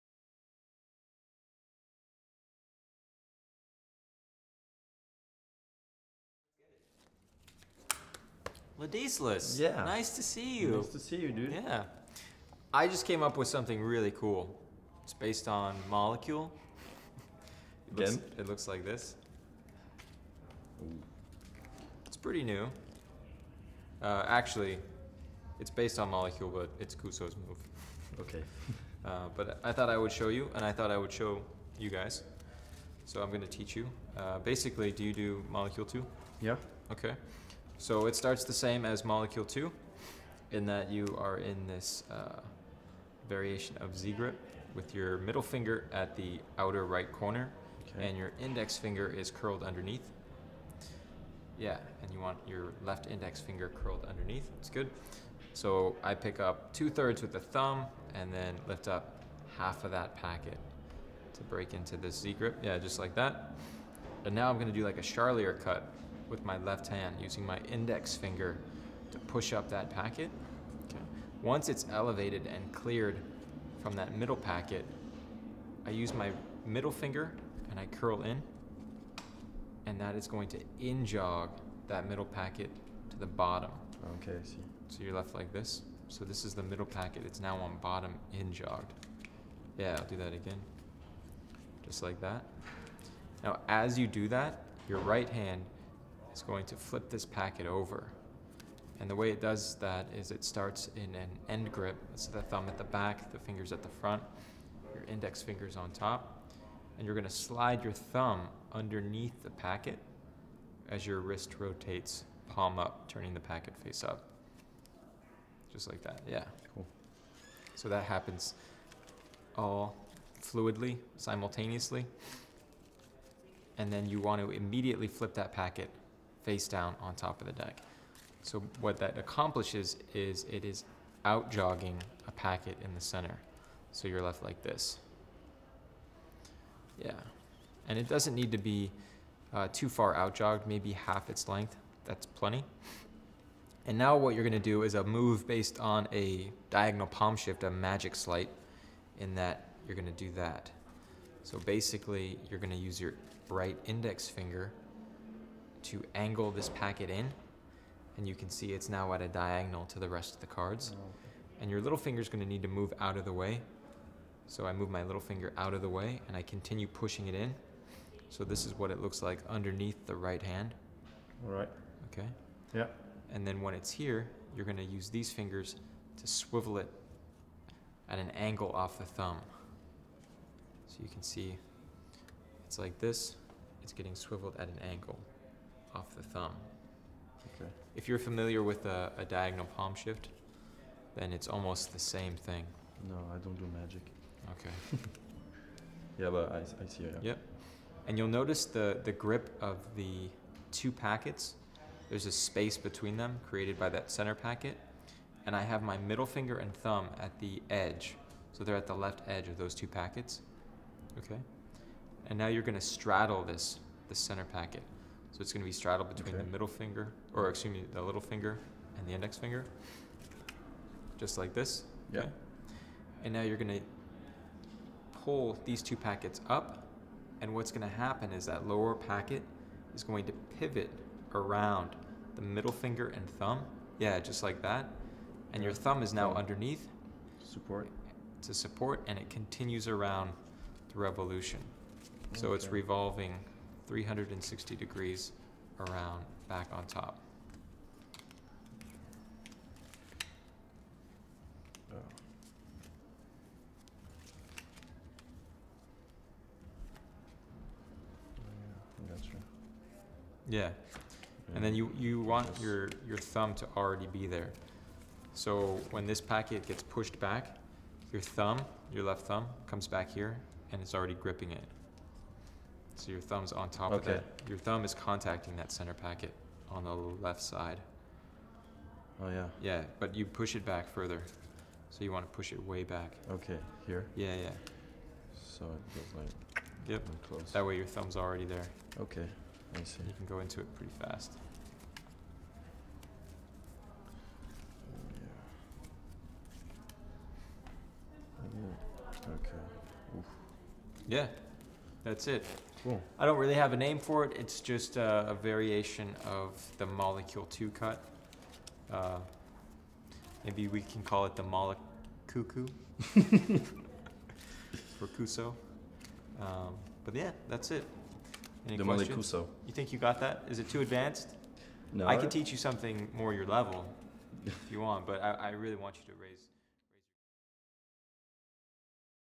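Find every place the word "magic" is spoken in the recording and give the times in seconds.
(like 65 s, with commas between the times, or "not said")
147 s, 193 s.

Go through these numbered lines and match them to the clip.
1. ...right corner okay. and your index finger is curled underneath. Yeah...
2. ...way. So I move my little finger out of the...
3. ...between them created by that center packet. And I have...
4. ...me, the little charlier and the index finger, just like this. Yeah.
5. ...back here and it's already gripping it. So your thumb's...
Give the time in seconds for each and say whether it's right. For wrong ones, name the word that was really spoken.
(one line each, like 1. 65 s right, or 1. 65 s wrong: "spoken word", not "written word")
1. 46 s right
2. 163 s right
3. 202 s right
4. 217 s wrong: "finger", not "charlier"
5. 269 s right.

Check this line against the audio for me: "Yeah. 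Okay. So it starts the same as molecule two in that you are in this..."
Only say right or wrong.
right.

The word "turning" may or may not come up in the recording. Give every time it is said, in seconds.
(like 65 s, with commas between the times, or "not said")
113 s.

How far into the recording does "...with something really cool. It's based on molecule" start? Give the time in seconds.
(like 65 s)
13 s.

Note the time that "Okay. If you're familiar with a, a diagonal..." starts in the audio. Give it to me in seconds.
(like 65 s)
187 s.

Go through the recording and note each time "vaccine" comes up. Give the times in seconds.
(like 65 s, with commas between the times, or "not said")
not said.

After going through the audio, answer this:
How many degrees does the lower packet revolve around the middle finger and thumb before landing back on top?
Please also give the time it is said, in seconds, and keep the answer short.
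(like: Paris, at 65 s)
360, at 243 s.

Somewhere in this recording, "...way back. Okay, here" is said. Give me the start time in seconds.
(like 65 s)
282 s.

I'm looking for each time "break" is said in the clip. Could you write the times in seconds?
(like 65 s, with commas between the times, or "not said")
61 s.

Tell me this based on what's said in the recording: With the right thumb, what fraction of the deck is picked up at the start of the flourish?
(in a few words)
two thirds.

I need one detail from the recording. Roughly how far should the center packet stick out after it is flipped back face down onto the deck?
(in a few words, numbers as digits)
half its length.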